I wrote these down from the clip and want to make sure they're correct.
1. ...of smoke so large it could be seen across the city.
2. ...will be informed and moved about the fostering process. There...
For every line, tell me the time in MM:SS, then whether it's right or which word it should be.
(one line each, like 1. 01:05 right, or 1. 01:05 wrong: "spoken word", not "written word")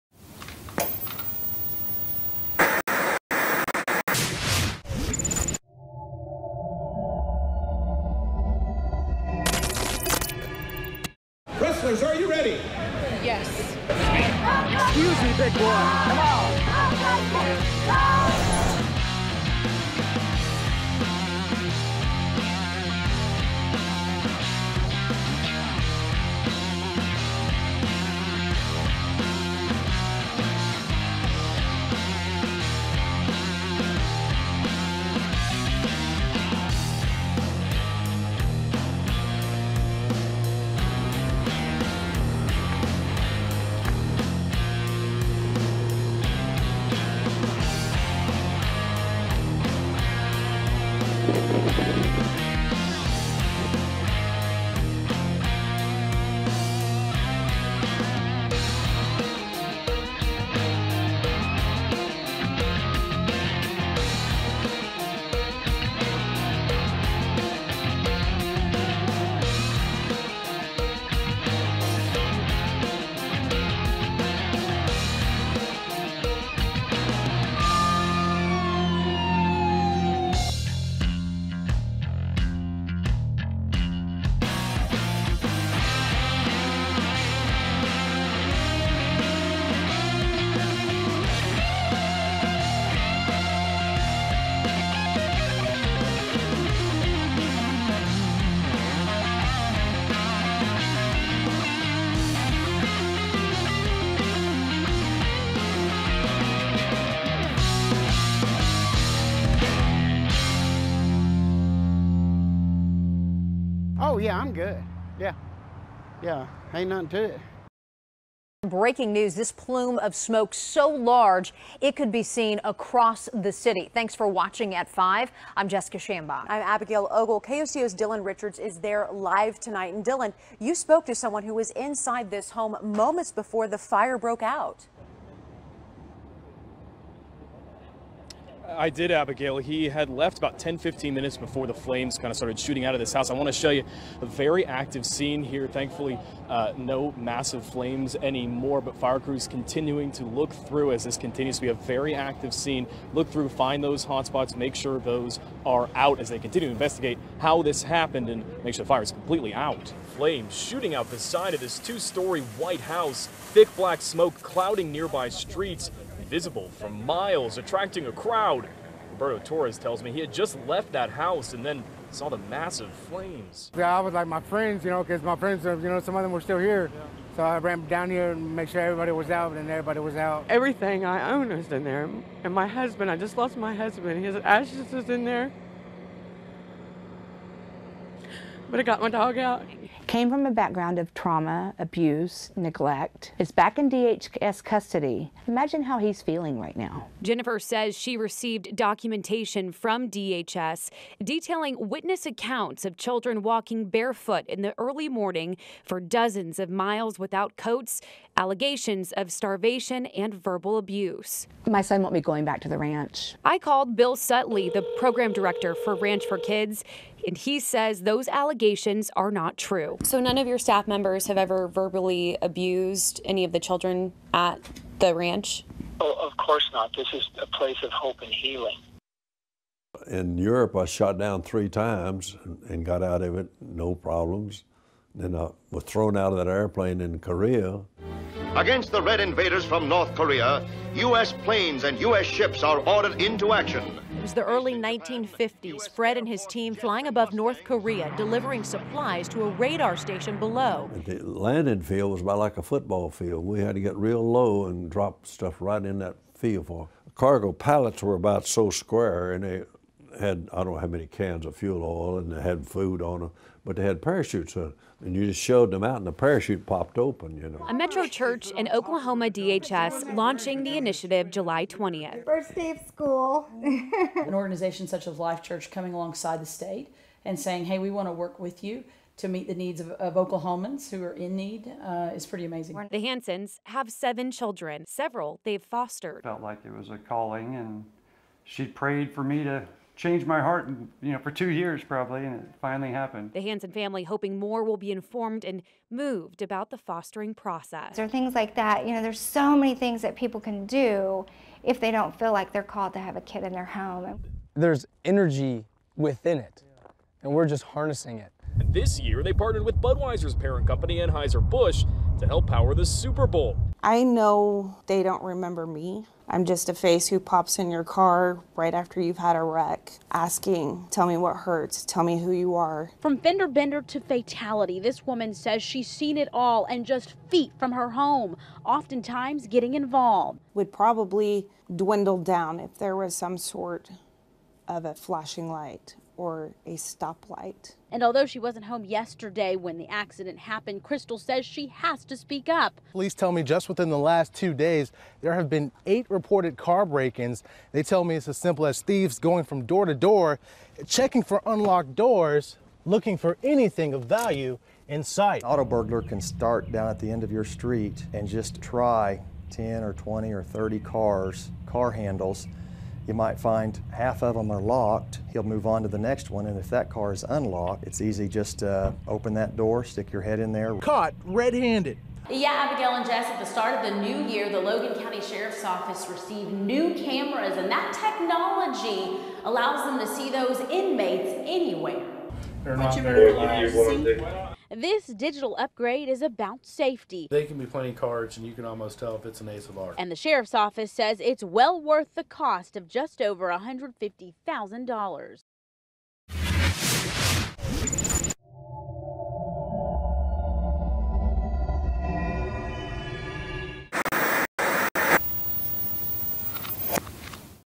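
1. 01:59 right
2. 04:54 right.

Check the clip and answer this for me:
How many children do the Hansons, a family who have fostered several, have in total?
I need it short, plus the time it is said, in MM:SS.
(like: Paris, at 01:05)
7, at 04:43.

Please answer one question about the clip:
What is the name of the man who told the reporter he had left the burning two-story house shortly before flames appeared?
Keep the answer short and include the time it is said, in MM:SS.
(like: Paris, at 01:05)
Roberto Torres, at 02:49.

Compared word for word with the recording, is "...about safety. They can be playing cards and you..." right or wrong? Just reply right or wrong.
right.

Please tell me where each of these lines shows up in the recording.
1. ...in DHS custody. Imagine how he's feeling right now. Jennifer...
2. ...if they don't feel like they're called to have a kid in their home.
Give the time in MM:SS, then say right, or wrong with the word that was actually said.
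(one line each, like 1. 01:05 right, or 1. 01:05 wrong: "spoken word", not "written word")
1. 03:13 right
2. 05:01 right.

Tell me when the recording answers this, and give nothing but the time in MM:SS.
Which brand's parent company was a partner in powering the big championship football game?
05:09.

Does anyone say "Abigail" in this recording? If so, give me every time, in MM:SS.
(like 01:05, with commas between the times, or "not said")
02:06, 02:19, 06:12.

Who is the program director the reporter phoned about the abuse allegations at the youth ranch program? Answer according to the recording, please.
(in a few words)
Bill Sutley.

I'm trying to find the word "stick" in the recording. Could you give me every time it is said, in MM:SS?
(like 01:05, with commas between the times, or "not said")
06:09.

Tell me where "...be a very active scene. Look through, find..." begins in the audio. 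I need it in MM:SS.
02:31.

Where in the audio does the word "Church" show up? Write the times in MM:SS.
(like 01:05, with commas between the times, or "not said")
04:28, 04:35.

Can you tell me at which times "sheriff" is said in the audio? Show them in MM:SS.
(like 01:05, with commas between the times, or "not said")
06:15, 06:30.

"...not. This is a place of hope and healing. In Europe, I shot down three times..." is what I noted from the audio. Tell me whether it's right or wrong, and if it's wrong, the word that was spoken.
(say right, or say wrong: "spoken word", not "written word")
right.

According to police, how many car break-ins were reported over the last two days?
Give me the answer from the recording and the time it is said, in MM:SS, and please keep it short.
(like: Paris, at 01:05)
8, at 05:45.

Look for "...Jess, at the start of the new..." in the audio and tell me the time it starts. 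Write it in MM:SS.
06:13.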